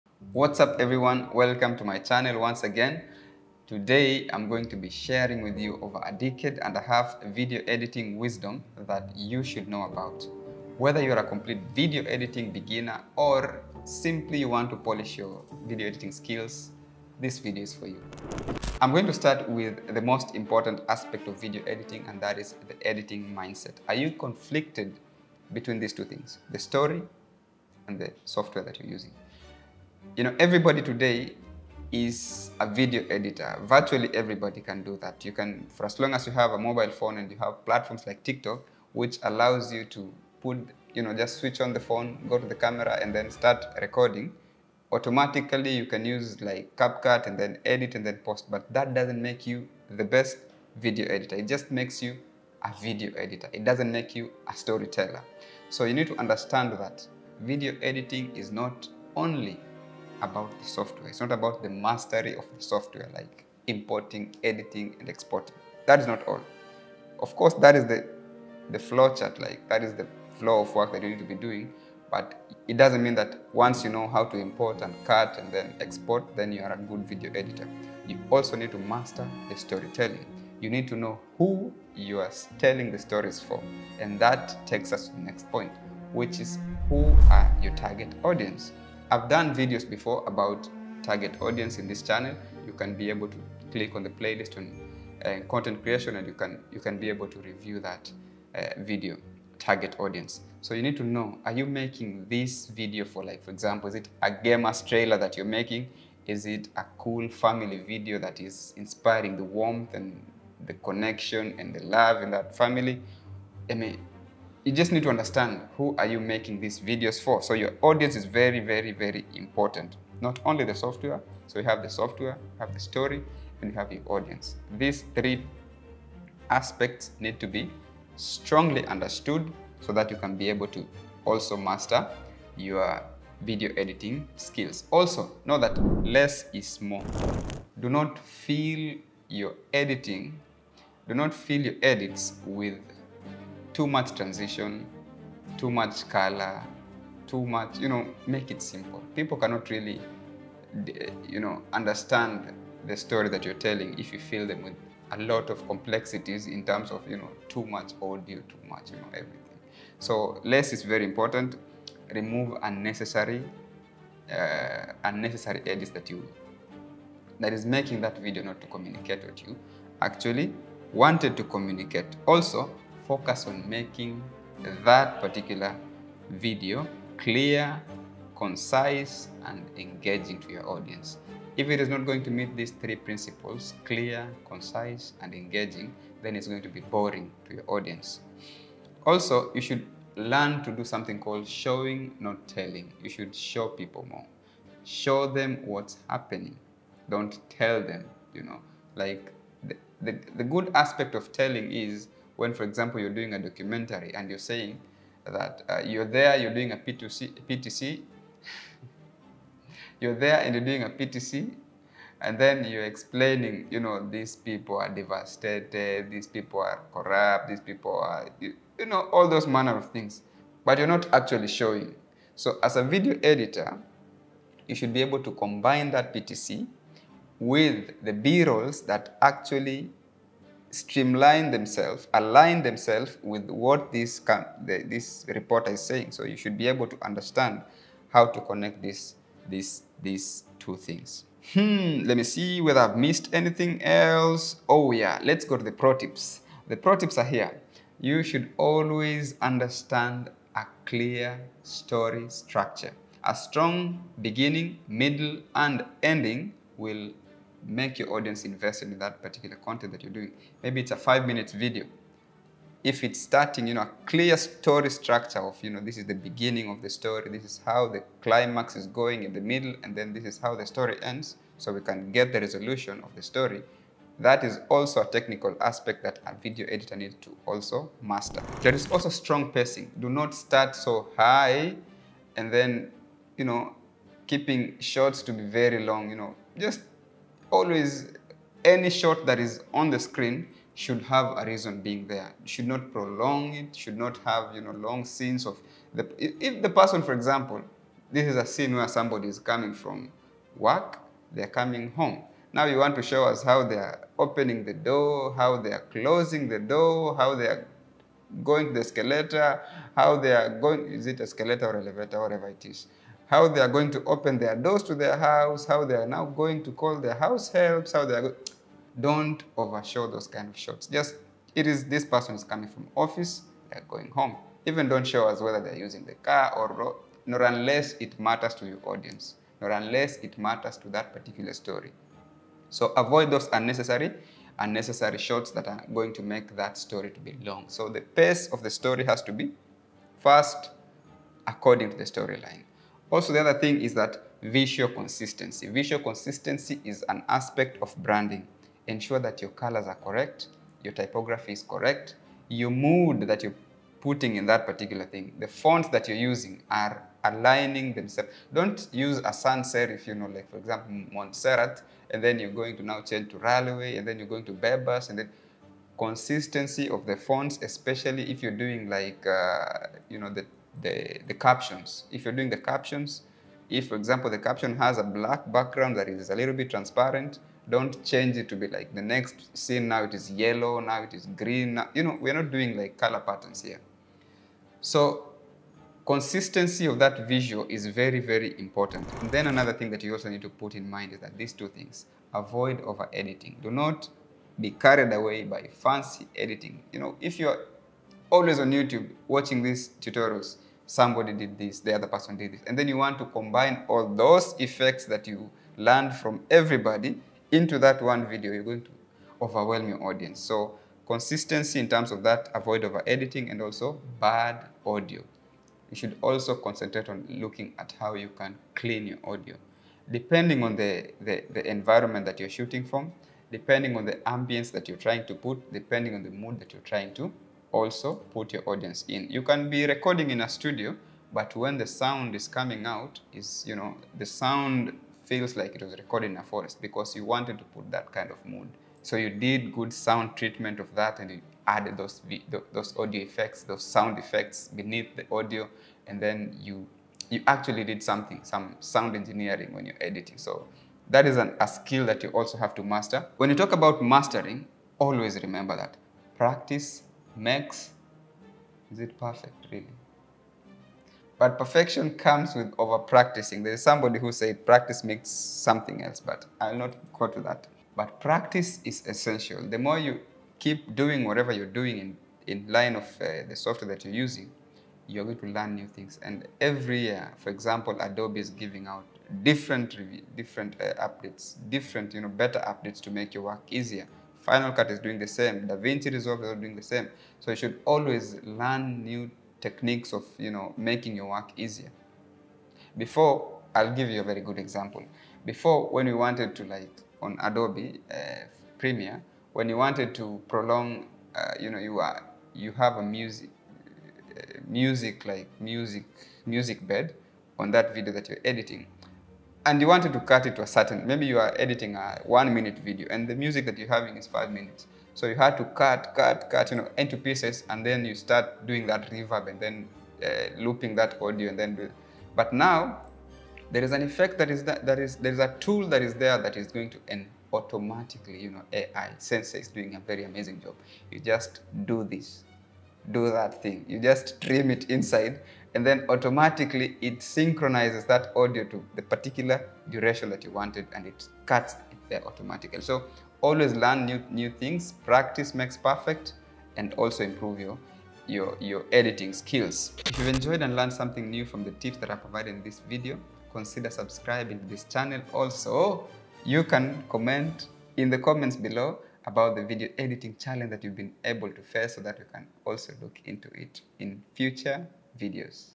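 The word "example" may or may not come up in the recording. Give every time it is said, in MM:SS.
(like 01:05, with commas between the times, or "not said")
01:43, 03:22, 04:57, 06:00, 06:13, 07:57, 08:14.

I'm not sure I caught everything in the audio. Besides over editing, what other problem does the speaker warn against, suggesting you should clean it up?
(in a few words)
Bad audio.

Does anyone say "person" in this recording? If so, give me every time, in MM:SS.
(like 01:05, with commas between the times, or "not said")
04:56, 05:22, 06:42.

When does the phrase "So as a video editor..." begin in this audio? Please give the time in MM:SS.
03:42.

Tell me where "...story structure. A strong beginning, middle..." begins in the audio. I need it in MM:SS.
04:11.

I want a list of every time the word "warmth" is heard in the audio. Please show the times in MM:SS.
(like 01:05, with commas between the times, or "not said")
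01:49.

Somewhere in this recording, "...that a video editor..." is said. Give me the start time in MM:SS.
04:36.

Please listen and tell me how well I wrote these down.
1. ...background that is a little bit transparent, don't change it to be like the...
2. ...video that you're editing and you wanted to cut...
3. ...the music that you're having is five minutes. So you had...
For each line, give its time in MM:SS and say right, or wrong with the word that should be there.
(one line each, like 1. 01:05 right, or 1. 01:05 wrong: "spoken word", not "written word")
1. 06:15 right
2. 08:27 right
3. 08:33 right.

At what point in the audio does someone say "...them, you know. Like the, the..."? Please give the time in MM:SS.
03:17.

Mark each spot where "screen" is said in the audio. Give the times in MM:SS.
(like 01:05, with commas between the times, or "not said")
04:49.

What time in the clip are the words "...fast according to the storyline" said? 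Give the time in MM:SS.
05:40.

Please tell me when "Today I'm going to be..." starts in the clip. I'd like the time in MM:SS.
00:03.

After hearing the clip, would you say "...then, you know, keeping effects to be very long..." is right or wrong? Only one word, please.
wrong.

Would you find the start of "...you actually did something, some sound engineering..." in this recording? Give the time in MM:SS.
07:27.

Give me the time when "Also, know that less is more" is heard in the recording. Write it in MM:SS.
02:14.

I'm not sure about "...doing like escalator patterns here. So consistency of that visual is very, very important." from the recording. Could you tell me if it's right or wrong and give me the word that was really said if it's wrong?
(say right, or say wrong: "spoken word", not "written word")
wrong: "color", not "escalator".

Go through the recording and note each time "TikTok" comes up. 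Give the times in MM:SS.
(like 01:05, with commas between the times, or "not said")
00:38.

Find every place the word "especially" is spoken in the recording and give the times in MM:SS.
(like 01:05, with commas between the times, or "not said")
06:07.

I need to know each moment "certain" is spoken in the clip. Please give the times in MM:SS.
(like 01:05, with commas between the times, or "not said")
08:30.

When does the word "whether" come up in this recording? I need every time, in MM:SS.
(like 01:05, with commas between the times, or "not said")
00:10, 04:02, 05:25.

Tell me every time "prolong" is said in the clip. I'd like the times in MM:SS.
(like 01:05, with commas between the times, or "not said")
04:52, 08:20.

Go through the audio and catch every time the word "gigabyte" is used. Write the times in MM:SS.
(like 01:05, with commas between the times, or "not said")
not said.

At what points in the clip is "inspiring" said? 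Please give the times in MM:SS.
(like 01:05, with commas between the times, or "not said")
01:48.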